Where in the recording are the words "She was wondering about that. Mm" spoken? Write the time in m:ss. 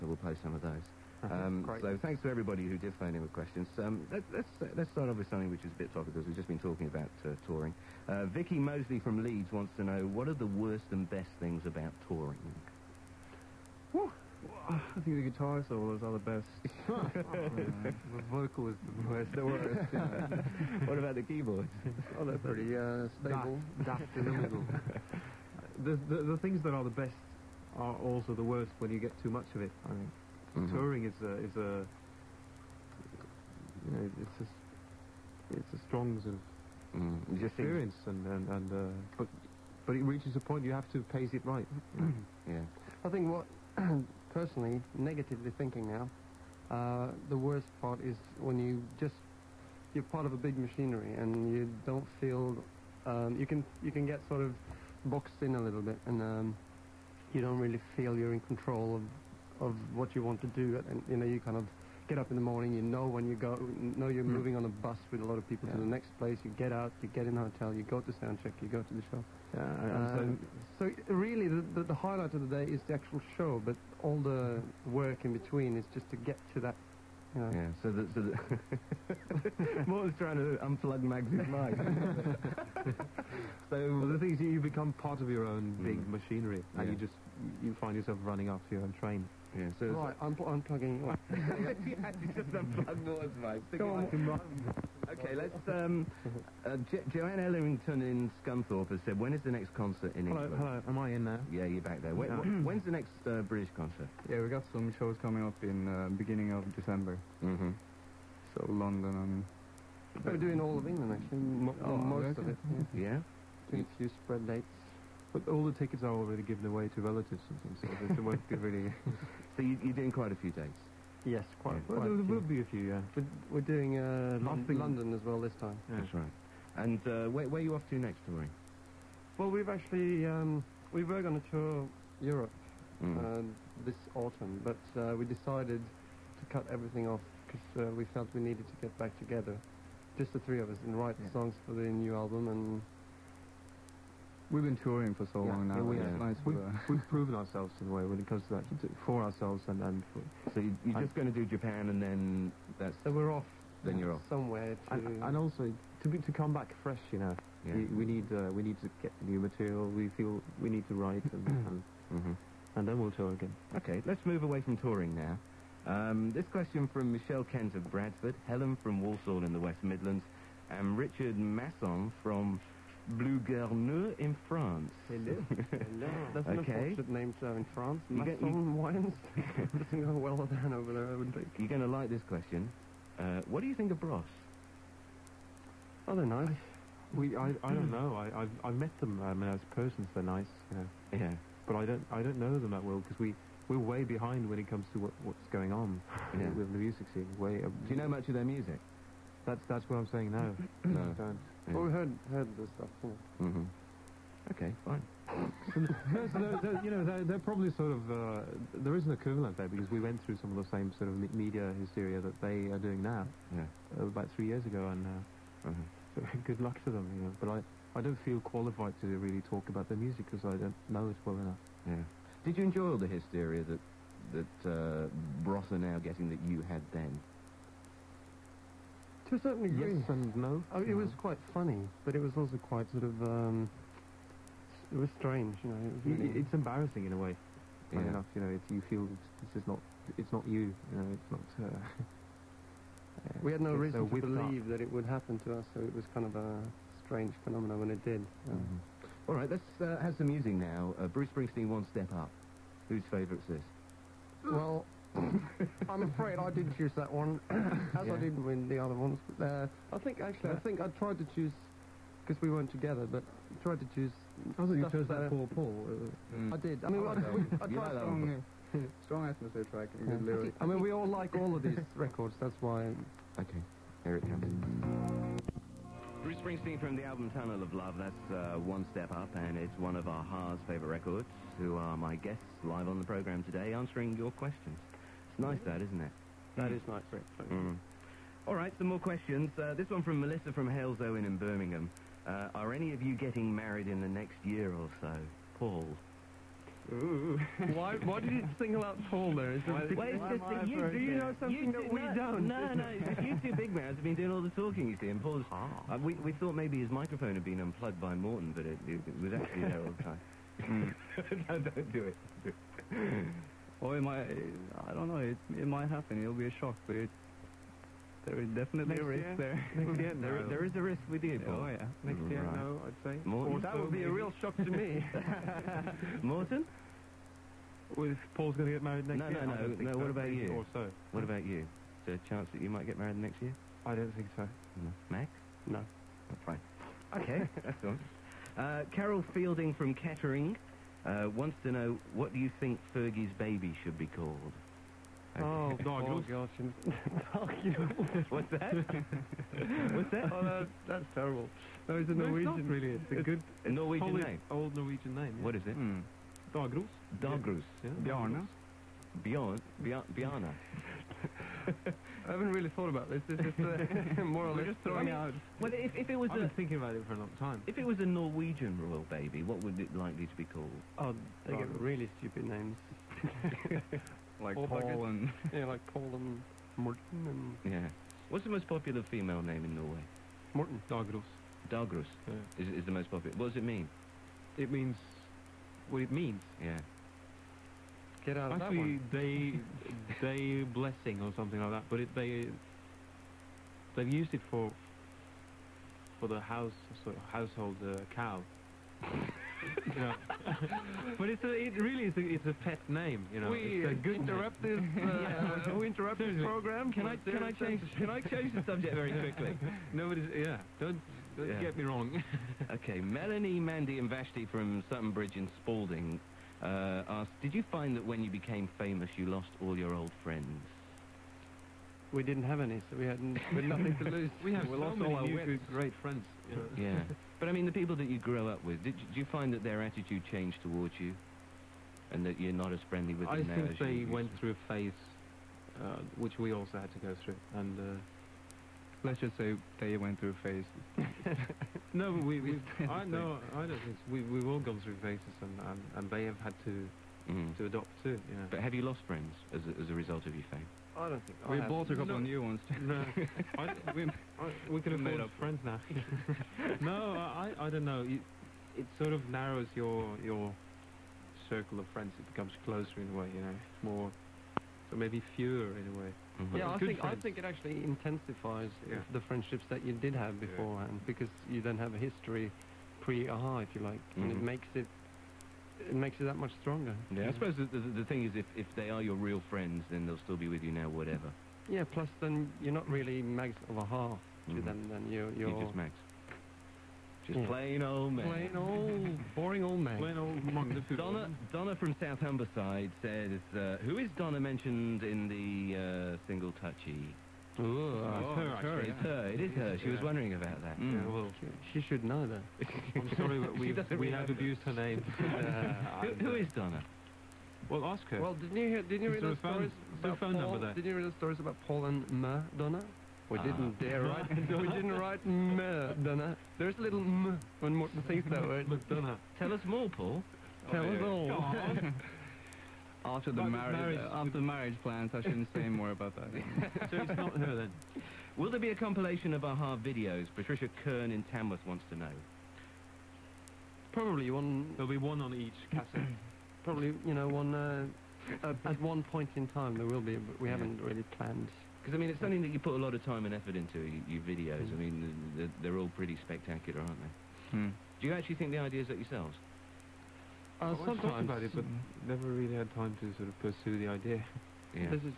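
8:19.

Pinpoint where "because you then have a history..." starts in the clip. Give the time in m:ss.
7:51.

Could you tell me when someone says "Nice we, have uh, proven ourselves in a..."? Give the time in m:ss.
2:26.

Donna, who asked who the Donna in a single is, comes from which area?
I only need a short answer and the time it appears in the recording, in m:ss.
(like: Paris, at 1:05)
South Humberside, at 8:12.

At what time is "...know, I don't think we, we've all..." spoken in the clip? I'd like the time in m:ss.
7:23.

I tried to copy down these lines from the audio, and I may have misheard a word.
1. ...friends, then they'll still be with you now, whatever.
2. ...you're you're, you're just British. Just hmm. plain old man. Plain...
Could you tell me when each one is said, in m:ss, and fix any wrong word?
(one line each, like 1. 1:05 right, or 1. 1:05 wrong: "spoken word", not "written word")
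1. 7:59 right
2. 8:05 wrong: "Max", not "British".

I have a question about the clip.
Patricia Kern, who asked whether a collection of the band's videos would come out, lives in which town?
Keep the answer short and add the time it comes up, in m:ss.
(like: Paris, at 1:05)
Tamworth, at 8:51.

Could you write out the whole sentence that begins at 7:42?
It becomes closer in a way, you know.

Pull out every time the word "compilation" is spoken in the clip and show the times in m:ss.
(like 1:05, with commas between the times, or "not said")
8:48.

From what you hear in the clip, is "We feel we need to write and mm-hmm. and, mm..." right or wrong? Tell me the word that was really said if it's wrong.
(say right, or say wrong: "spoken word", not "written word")
right.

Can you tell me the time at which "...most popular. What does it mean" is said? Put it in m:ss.
6:22.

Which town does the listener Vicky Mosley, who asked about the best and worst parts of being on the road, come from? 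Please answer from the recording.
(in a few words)
Leeds.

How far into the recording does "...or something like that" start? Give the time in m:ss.
6:31.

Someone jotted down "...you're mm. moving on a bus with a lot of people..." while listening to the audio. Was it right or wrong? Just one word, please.
right.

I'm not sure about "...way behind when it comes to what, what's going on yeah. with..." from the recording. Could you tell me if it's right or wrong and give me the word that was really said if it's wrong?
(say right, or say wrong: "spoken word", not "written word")
right.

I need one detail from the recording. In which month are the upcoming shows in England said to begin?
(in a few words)
December.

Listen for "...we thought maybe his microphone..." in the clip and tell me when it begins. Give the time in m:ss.
5:06.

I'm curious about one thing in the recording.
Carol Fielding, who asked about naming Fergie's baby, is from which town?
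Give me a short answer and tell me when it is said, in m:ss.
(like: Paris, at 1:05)
Kettering, at 5:39.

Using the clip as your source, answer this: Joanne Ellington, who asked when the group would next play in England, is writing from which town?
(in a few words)
Scunthorpe.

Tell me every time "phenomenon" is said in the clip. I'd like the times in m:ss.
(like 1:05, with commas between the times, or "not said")
4:07.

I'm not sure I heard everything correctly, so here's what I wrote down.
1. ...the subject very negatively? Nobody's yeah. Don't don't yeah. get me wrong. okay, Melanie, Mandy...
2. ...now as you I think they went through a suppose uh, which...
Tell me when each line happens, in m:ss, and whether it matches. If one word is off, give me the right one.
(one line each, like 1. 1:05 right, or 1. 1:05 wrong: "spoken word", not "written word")
1. 6:48 wrong: "quickly", not "negatively"
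2. 7:13 wrong: "phase", not "suppose".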